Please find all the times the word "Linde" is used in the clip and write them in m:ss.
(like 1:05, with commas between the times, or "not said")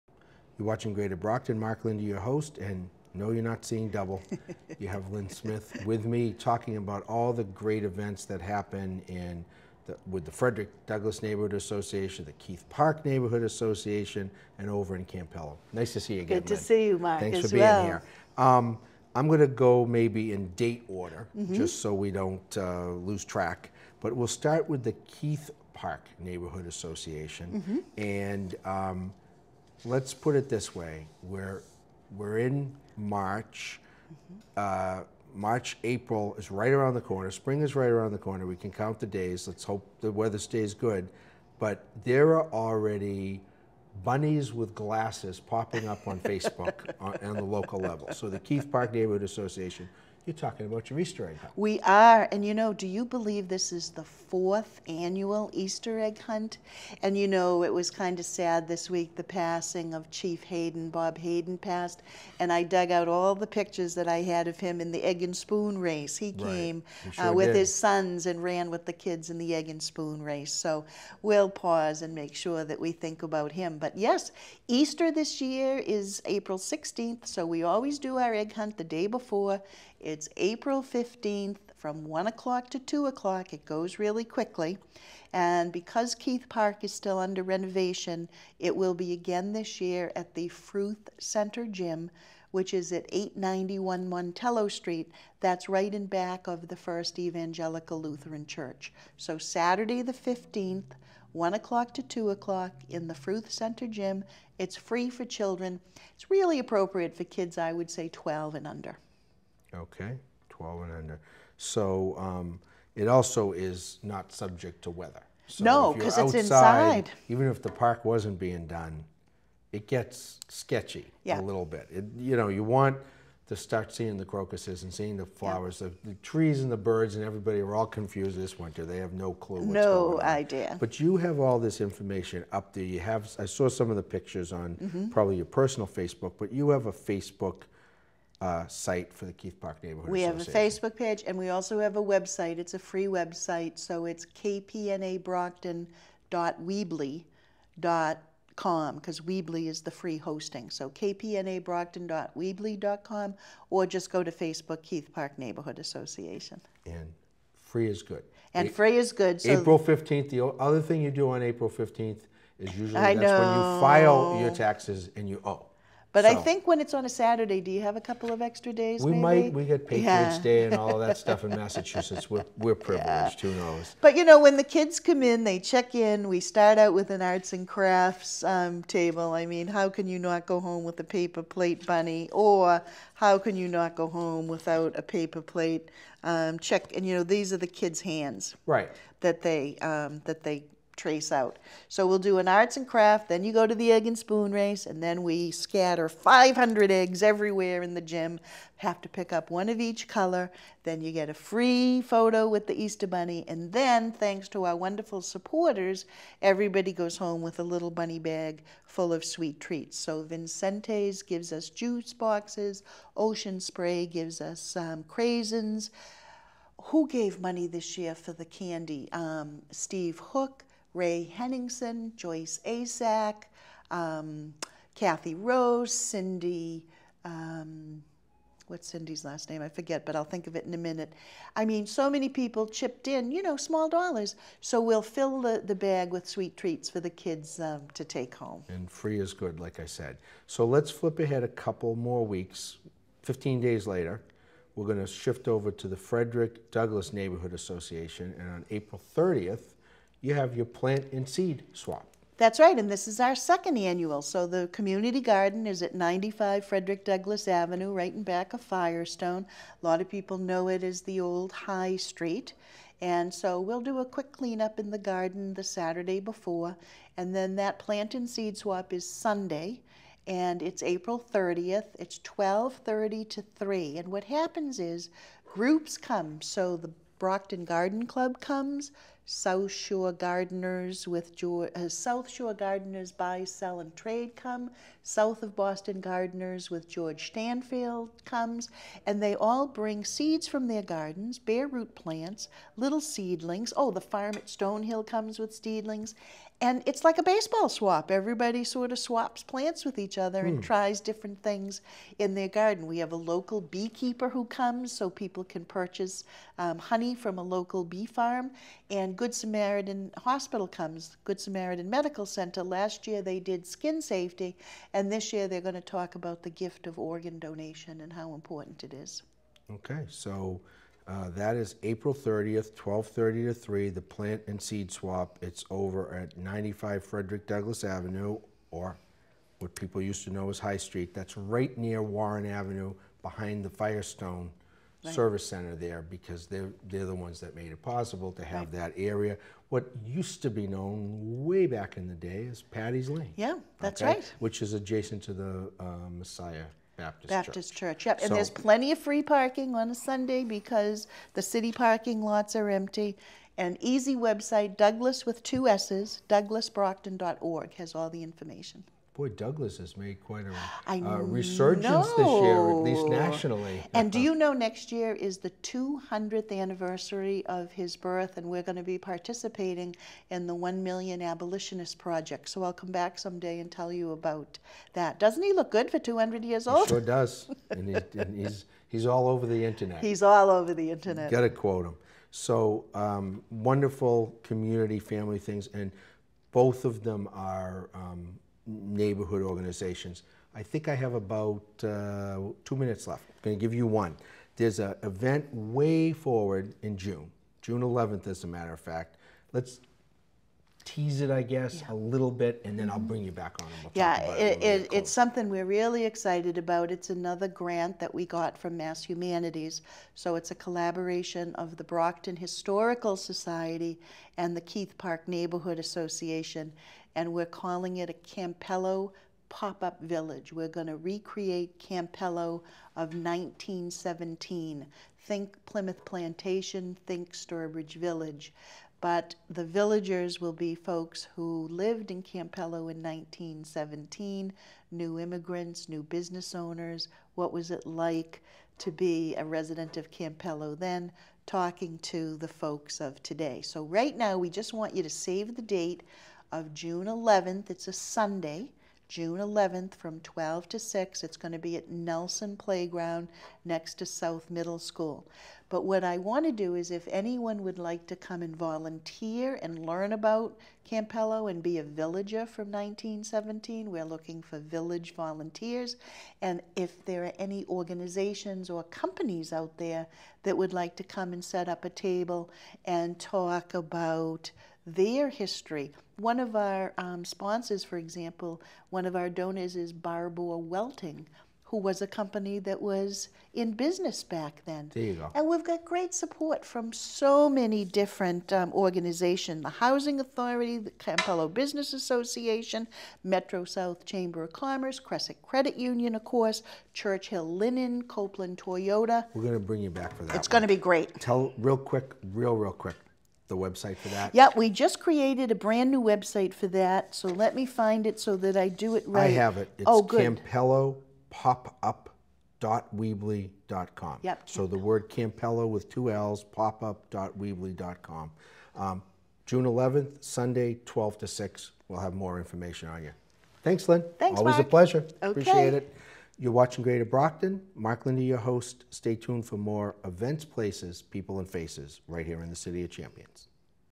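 0:01, 8:48.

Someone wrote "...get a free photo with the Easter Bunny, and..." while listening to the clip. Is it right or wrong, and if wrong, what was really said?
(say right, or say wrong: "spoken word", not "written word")
right.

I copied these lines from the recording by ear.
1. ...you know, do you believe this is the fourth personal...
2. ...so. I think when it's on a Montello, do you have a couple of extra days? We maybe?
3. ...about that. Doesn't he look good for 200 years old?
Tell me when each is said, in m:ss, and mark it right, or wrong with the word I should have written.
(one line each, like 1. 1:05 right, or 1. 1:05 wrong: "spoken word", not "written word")
1. 0:52 wrong: "annual", not "personal"
2. 2:46 wrong: "Saturday", not "Montello"
3. 6:14 right.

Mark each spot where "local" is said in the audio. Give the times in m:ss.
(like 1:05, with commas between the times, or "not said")
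0:47, 5:03, 5:07.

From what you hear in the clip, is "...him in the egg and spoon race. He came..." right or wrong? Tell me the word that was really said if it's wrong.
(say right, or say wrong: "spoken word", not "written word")
right.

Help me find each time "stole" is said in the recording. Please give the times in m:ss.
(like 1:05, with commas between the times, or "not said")
not said.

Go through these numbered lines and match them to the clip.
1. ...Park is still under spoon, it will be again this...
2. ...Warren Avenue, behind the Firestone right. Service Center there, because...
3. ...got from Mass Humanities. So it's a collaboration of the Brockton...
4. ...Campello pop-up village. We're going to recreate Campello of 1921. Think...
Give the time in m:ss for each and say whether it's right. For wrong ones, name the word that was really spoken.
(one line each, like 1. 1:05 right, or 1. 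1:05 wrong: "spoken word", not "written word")
1. 1:26 wrong: "renovation", not "spoon"
2. 5:32 right
3. 6:48 right
4. 6:58 wrong: "1917", not "1921".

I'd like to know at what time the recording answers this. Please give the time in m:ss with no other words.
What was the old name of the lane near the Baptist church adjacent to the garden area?
5:42.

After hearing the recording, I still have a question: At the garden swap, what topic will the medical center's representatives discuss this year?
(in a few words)
organ donation.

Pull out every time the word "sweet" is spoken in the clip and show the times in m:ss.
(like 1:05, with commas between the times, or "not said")
3:29, 3:56.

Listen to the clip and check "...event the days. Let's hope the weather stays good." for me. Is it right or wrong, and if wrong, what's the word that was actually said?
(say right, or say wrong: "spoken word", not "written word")
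wrong: "count", not "event".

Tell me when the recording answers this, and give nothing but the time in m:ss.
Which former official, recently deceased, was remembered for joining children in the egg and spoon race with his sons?
1:00.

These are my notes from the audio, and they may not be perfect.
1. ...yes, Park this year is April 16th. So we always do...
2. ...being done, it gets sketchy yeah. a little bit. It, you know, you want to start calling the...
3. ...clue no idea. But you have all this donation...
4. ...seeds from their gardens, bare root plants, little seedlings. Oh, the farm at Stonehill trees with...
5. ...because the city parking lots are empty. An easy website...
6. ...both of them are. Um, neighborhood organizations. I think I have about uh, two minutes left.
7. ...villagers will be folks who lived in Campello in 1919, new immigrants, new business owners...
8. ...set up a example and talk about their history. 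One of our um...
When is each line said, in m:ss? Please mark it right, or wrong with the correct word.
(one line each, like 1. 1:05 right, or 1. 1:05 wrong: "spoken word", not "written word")
1. 1:13 wrong: "Easter", not "Park"
2. 1:58 wrong: "seeing", not "calling"
3. 2:09 wrong: "information", not "donation"
4. 4:50 wrong: "comes", not "trees"
5. 5:50 right
6. 6:26 right
7. 7:09 wrong: "1917", not "1919"
8. 7:51 wrong: "table", not "example".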